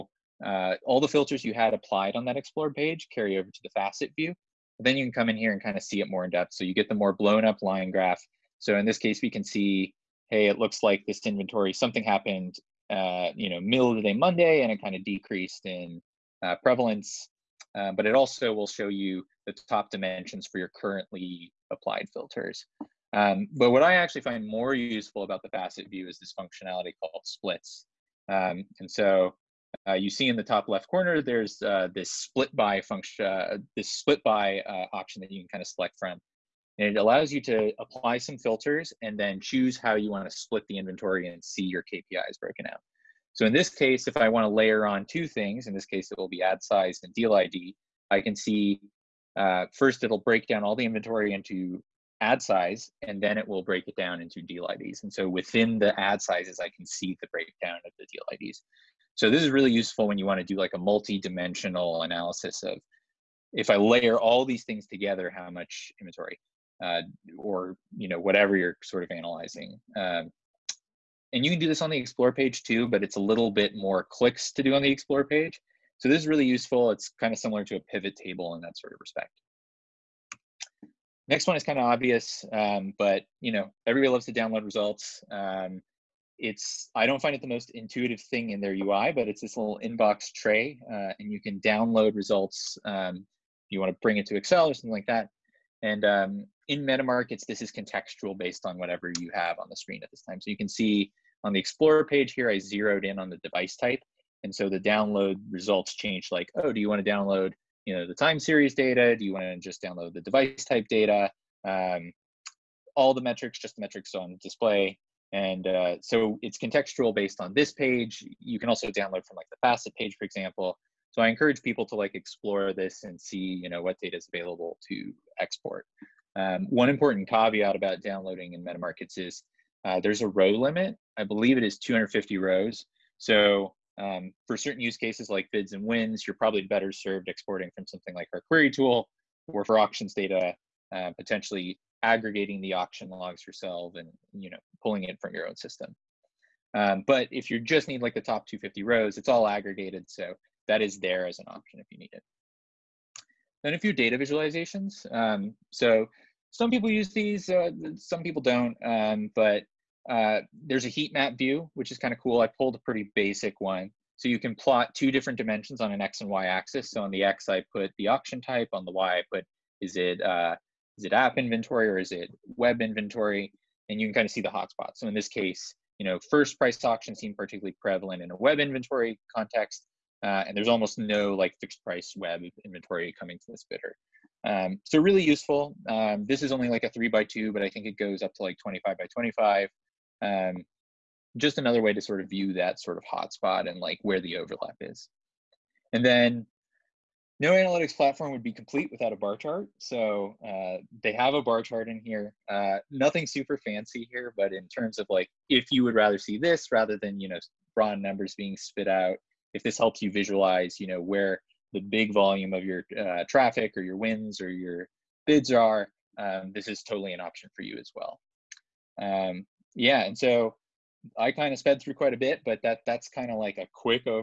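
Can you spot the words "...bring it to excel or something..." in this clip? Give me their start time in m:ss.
1:34.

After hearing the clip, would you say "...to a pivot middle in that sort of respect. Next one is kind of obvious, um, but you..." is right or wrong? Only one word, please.
wrong.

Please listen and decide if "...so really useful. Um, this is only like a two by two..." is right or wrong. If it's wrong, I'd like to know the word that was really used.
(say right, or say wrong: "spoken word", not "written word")
wrong: "three", not "two".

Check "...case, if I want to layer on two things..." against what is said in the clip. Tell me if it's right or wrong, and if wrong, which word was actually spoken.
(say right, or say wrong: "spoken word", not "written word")
right.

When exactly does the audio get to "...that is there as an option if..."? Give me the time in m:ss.
2:30.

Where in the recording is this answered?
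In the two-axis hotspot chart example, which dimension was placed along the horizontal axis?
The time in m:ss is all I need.
2:48.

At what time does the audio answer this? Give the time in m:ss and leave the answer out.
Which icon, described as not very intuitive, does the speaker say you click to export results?
1:29.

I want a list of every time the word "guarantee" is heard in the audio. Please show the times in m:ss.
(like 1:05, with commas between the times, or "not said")
not said.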